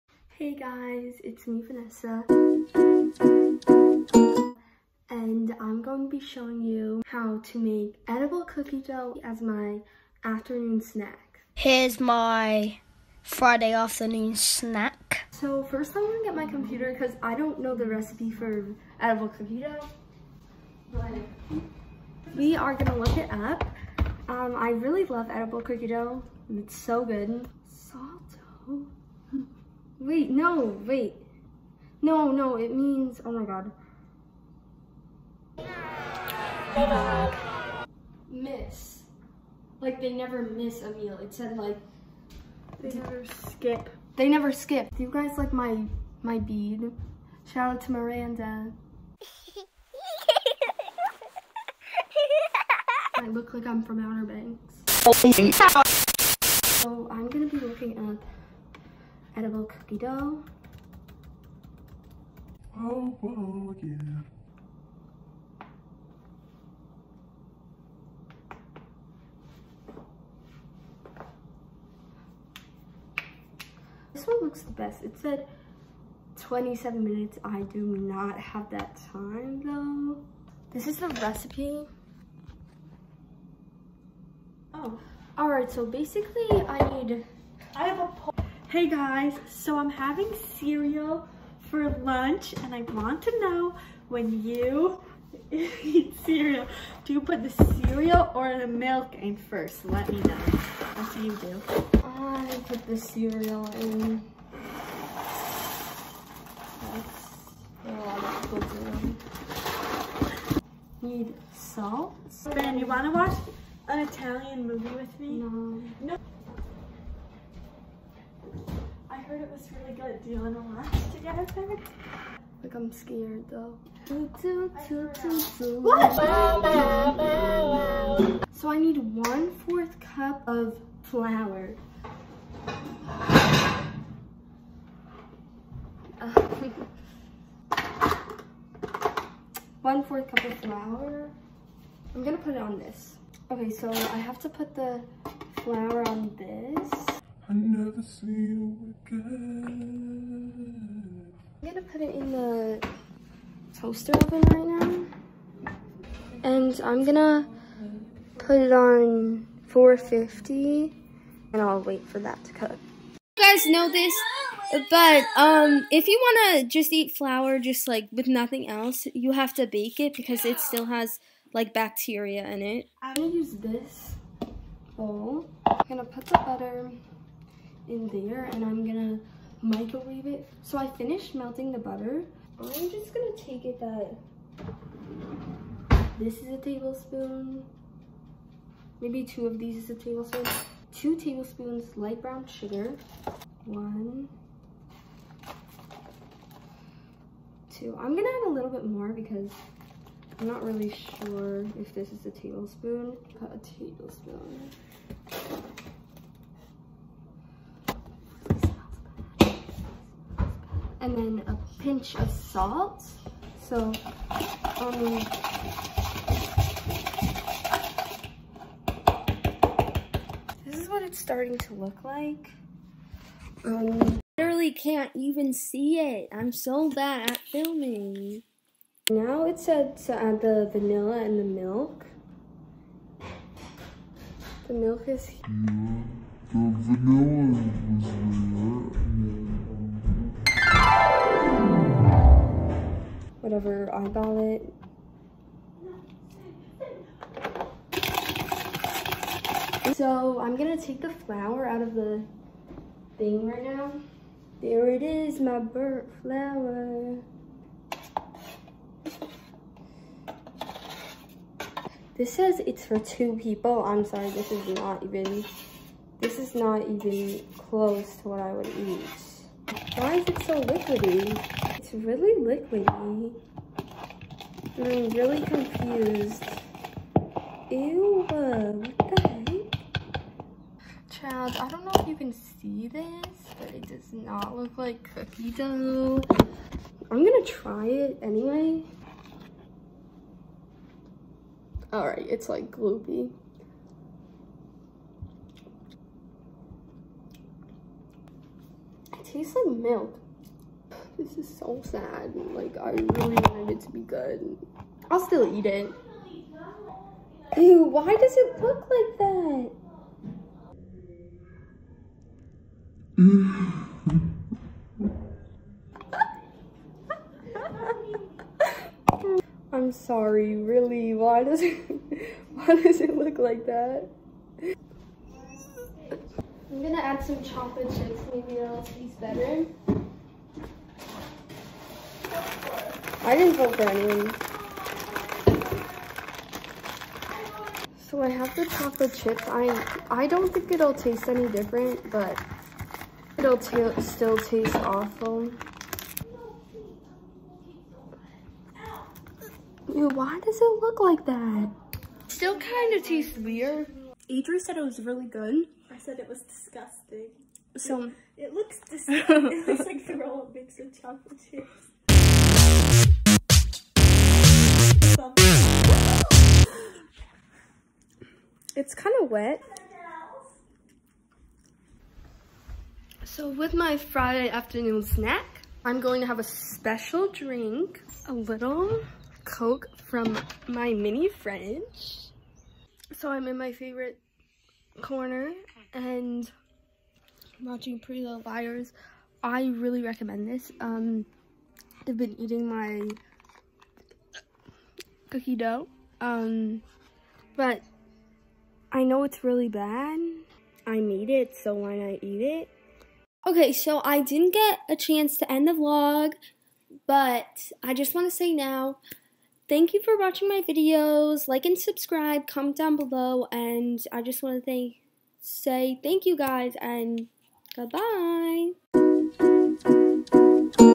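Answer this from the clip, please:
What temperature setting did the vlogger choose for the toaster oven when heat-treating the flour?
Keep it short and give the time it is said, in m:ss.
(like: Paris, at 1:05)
450, at 2:39.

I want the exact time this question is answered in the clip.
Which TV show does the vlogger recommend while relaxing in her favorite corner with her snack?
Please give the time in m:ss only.
6:27.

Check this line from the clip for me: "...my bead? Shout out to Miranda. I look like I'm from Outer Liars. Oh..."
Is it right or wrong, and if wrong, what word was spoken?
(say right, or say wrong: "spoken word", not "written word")
wrong: "Banks", not "Liars".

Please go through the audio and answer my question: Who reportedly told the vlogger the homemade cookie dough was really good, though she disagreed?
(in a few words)
Adri.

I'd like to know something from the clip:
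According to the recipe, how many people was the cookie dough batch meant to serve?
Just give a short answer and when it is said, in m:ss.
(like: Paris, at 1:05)
2, at 4:22.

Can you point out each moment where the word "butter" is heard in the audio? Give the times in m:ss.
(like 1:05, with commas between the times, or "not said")
2:56, 3:01.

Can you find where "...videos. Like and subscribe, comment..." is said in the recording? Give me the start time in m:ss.
6:50.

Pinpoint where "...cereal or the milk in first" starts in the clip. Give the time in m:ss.
1:37.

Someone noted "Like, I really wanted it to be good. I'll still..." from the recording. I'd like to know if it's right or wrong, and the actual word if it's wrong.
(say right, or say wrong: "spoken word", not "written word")
right.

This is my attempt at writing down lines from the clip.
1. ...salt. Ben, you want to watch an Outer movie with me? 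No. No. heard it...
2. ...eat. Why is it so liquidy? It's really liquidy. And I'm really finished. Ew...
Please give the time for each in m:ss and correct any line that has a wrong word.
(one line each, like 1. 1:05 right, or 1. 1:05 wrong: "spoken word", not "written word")
1. 1:51 wrong: "Italian", not "Outer"
2. 4:28 wrong: "confused", not "finished".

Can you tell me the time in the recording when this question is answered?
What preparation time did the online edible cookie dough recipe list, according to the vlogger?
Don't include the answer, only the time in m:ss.
1:16.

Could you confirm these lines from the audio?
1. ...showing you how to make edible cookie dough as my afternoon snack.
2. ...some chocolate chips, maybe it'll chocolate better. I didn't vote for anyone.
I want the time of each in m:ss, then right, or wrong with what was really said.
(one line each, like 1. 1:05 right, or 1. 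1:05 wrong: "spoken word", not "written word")
1. 0:06 right
2. 5:27 wrong: "taste", not "chocolate".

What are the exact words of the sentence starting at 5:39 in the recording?
I I don't think it'll taste any different, but it'll still taste awful.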